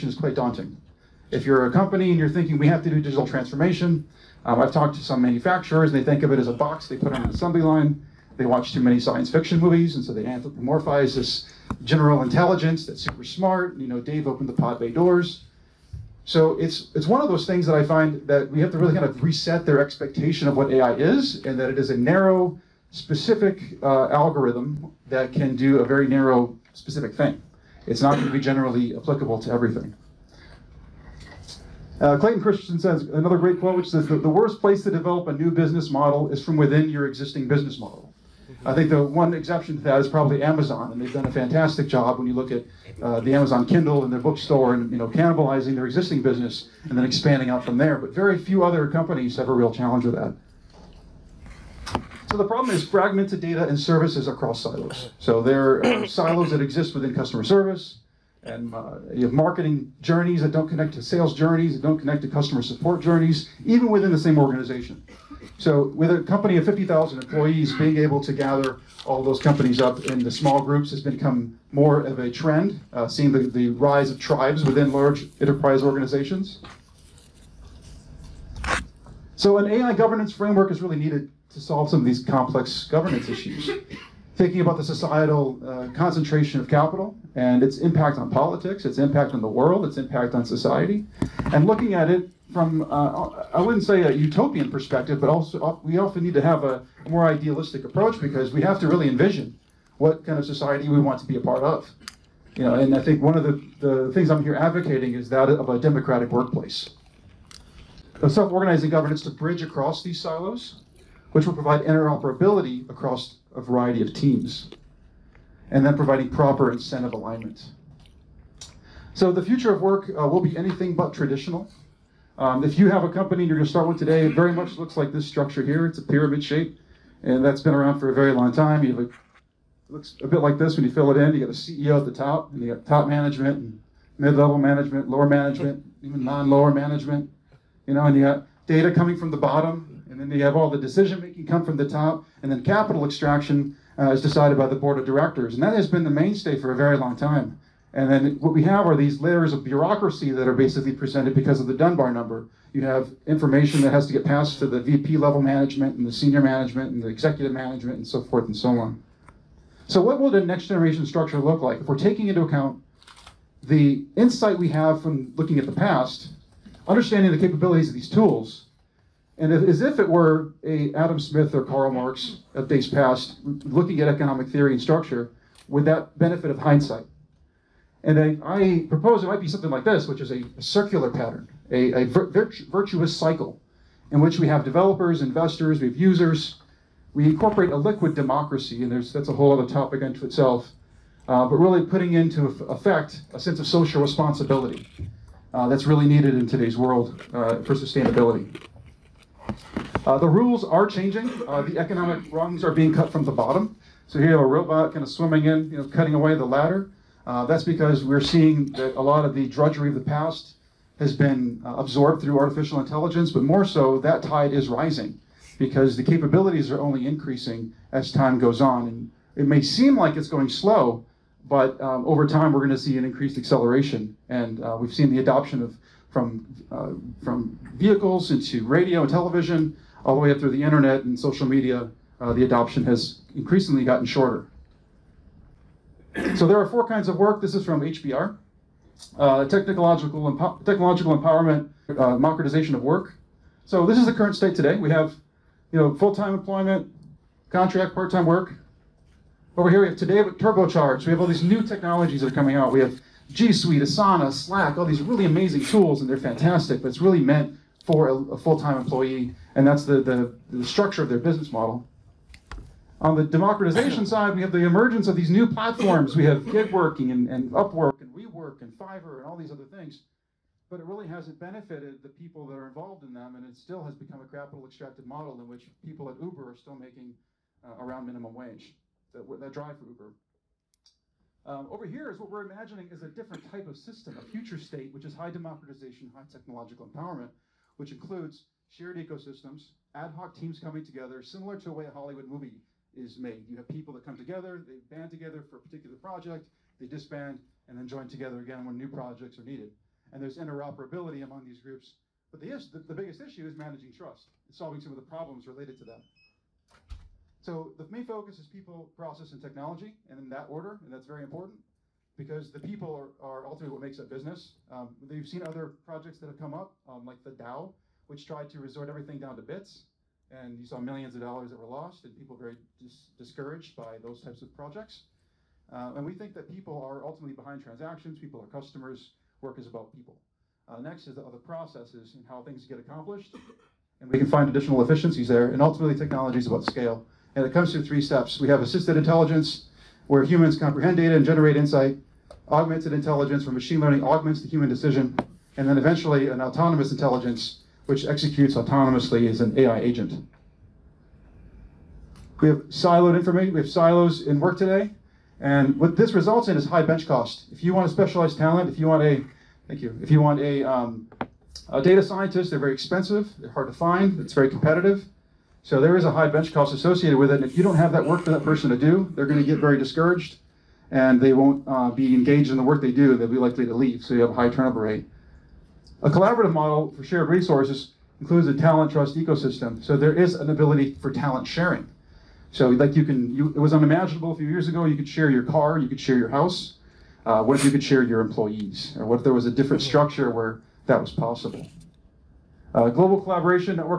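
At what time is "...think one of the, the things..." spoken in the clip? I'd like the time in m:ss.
1:43.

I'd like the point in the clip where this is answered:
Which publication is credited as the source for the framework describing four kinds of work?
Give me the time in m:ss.
3:57.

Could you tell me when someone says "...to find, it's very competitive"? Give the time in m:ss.
6:03.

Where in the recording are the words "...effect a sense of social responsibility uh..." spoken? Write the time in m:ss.
3:12.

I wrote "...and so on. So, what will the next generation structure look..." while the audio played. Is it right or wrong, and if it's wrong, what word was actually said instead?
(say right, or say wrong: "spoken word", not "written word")
right.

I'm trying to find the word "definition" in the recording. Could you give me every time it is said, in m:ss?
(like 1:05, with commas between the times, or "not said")
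not said.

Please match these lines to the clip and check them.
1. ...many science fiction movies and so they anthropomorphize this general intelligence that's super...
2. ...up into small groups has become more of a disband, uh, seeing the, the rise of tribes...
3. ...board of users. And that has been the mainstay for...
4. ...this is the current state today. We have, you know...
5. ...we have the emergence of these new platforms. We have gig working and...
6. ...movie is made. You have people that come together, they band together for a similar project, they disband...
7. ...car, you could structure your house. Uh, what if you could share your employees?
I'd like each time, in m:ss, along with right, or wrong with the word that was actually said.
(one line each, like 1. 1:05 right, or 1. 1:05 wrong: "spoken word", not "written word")
1. 0:08 right
2. 1:09 wrong: "trend", not "disband"
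3. 2:24 wrong: "directors", not "users"
4. 4:03 right
5. 4:24 right
6. 4:52 wrong: "particular", not "similar"
7. 6:25 wrong: "share", not "structure".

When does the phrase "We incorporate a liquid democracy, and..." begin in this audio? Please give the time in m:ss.
3:07.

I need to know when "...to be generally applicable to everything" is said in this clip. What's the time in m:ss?
0:28.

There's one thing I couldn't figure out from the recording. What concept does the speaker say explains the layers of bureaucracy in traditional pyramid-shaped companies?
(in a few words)
Dunbar number.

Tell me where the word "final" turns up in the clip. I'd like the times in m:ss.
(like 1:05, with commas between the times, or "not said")
not said.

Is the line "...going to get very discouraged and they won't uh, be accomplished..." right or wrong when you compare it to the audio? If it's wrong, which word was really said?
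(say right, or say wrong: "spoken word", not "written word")
wrong: "engaged", not "accomplished".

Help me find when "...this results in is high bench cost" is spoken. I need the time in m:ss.
5:55.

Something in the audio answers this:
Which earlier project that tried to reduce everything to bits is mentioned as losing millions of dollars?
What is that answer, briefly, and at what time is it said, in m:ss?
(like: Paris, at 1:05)
the DAO, at 5:17.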